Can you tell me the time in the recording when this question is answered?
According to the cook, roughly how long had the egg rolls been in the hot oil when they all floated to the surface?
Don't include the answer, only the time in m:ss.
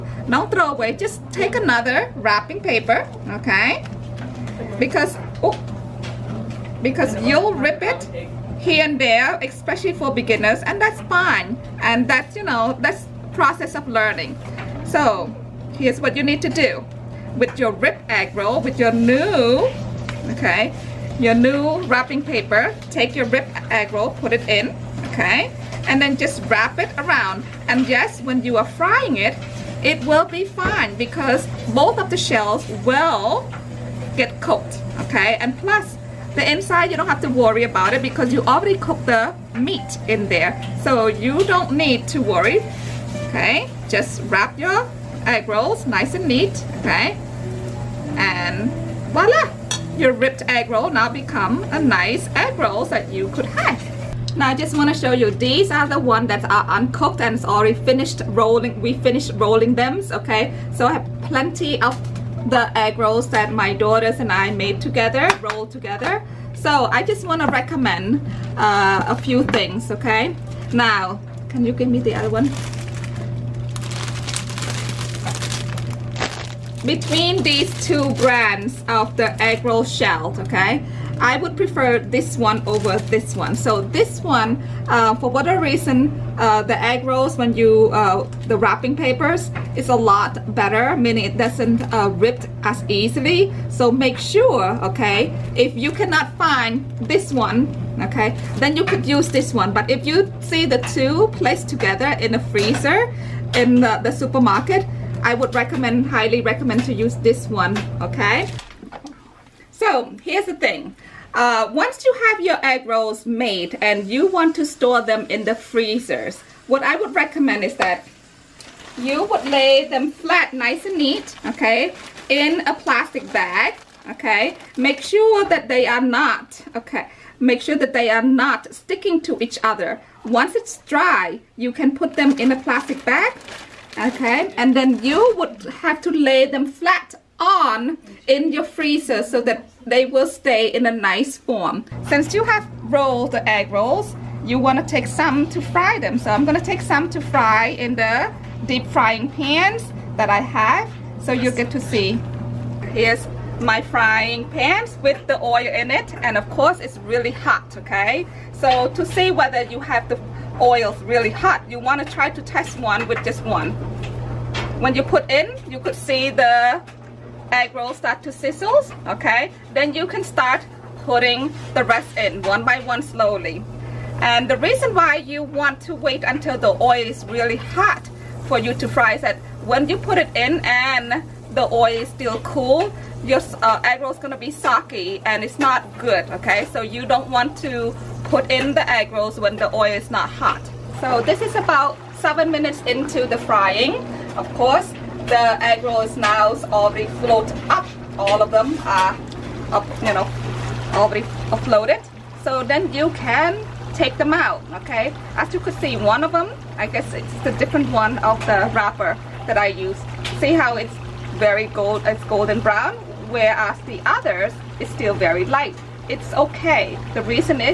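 3:12.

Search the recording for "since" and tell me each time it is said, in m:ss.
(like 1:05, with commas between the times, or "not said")
2:22.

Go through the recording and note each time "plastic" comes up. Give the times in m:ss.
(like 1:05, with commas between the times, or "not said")
2:02, 2:12.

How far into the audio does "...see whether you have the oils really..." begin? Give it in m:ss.
2:39.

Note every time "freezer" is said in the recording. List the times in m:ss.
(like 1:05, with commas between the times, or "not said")
1:42, 1:55, 2:18.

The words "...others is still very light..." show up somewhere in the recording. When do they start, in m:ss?
3:34.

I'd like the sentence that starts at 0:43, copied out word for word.
Just wrap your egg rolls nice and neat, okay?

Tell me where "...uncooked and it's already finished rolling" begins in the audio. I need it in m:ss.
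0:56.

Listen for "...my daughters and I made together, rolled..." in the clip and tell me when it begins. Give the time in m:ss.
1:03.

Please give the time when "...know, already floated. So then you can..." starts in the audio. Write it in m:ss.
3:20.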